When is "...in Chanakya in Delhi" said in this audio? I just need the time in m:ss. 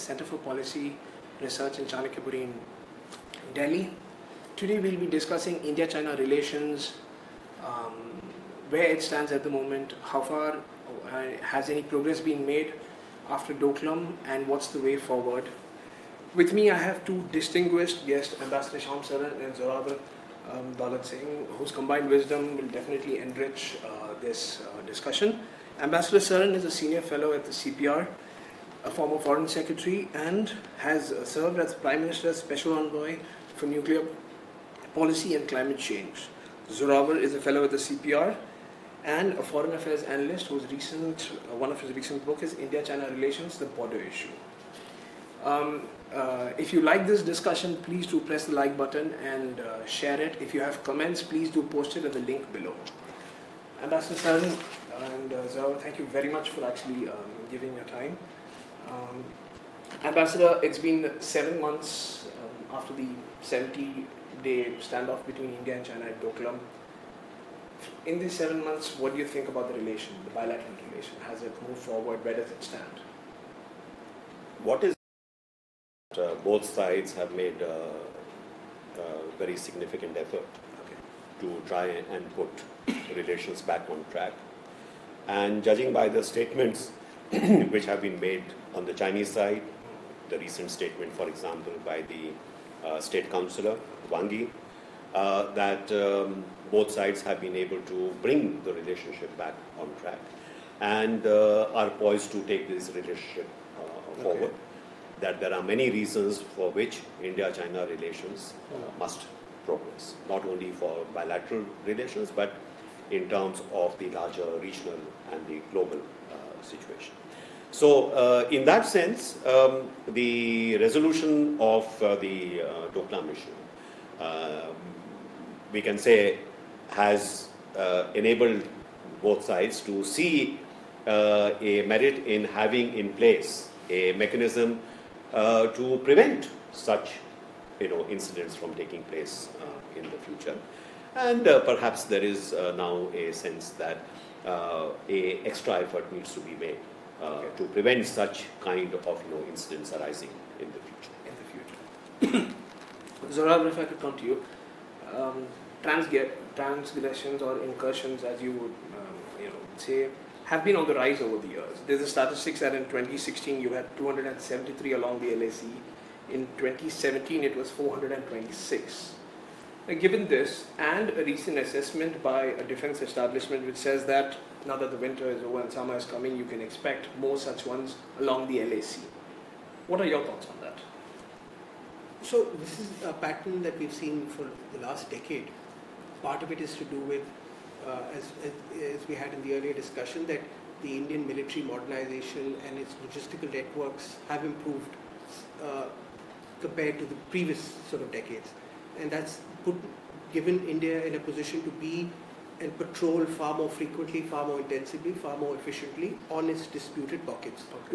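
0:01.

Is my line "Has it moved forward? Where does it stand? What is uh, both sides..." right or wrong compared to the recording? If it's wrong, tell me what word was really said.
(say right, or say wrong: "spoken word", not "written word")
right.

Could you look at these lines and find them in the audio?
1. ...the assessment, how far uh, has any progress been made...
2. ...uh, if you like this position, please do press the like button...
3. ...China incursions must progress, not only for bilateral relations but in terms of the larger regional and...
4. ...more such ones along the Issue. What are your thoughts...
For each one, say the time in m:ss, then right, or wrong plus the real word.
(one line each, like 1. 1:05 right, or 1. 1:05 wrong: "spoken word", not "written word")
1. 0:09 wrong: "moment", not "assessment"
2. 0:46 wrong: "discussion", not "position"
3. 1:47 wrong: "relations", not "incursions"
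4. 2:57 wrong: "LAC", not "Issue".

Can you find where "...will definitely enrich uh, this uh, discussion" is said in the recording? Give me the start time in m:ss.
0:22.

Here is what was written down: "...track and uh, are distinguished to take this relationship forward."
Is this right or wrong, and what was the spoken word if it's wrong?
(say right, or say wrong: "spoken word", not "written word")
wrong: "poised", not "distinguished".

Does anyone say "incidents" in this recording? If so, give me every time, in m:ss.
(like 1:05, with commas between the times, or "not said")
2:18, 2:29.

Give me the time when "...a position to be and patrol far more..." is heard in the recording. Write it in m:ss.
3:21.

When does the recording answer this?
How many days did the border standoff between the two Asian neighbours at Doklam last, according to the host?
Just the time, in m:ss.
1:03.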